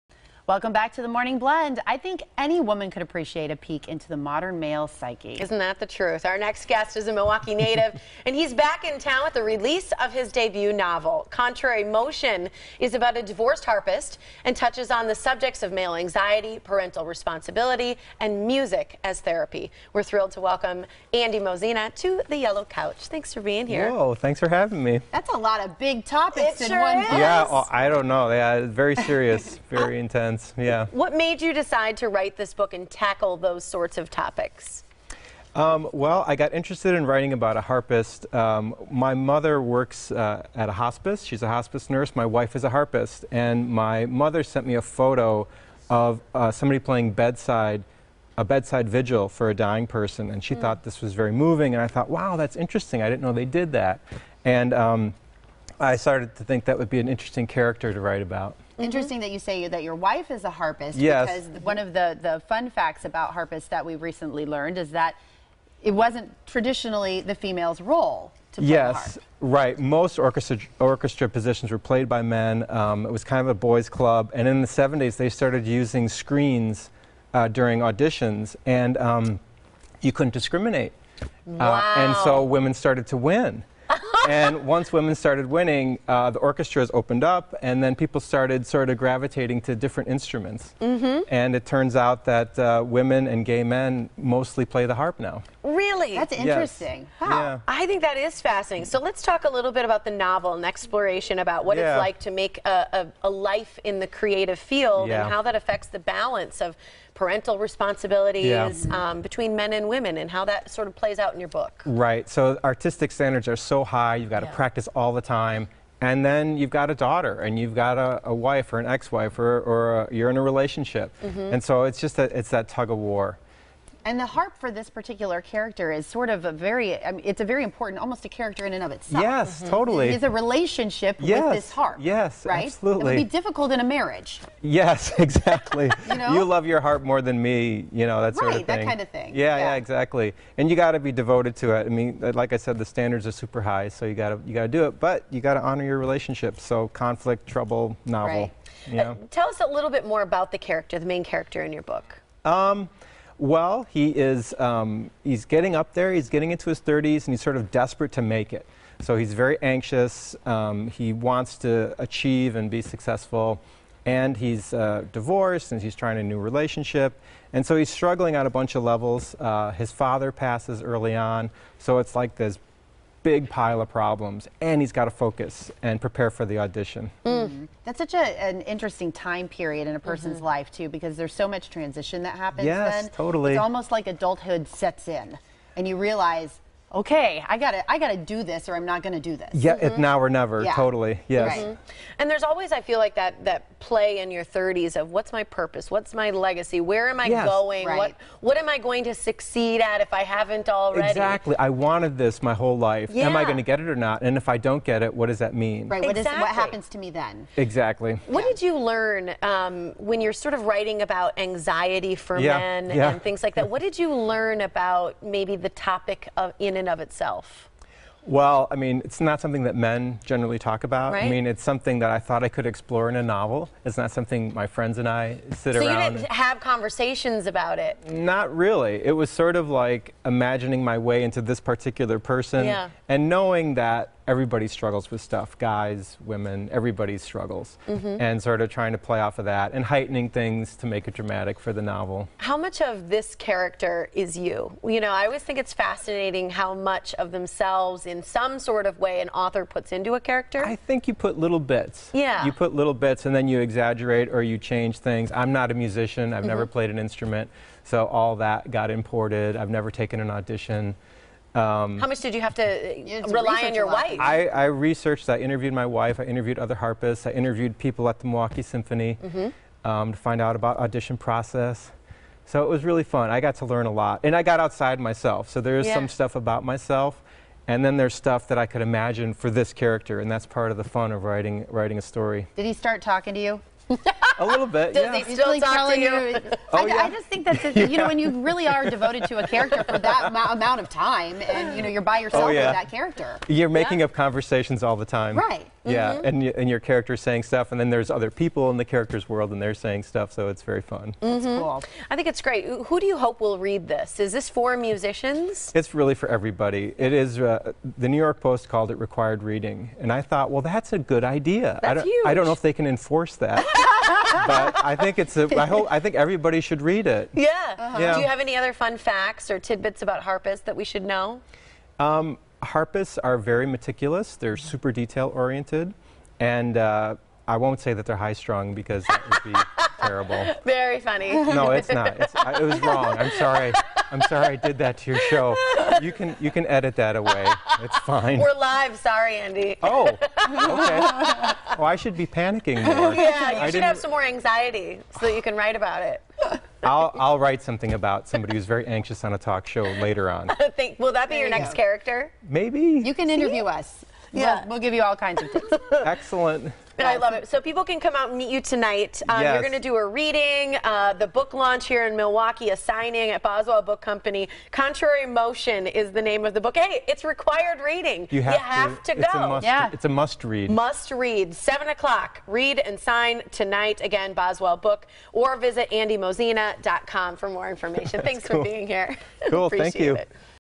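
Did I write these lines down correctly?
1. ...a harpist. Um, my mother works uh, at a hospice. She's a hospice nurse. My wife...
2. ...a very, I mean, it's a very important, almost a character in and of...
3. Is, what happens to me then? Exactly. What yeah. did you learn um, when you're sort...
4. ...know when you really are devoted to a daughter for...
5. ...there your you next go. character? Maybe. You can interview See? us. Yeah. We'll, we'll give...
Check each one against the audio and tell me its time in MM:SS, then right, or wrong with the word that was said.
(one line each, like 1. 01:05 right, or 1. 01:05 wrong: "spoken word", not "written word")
1. 00:37 right
2. 02:06 right
3. 03:26 right
4. 04:47 wrong: "character", not "daughter"
5. 05:51 right.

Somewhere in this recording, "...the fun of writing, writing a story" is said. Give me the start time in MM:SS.
04:40.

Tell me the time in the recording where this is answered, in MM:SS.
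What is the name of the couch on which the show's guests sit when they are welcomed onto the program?
00:22.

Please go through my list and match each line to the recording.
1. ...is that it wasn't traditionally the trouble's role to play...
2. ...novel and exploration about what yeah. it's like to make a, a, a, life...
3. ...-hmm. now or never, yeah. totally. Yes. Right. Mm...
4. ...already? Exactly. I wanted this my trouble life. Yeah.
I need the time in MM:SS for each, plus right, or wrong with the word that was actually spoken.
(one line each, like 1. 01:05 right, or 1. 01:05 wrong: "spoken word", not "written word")
1. 01:04 wrong: "female", not "trouble"
2. 01:40 right
3. 03:09 right
4. 03:20 wrong: "whole", not "trouble".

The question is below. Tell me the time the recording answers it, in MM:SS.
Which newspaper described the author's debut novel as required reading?
05:08.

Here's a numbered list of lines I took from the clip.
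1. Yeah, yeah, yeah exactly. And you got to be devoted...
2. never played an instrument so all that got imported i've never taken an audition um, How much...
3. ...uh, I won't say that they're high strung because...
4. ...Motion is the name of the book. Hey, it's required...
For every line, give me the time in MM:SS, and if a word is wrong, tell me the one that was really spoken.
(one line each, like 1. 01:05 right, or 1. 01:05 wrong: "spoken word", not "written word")
1. 02:19 right
2. 04:16 right
3. 05:26 right
4. 06:05 right.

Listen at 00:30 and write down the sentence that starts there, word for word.
What made you decide to write this book and tackle those sorts of topics?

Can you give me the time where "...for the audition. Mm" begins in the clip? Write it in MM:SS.
02:56.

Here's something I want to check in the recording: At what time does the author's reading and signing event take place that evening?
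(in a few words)
7 o'clock.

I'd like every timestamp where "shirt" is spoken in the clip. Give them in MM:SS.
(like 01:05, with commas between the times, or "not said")
not said.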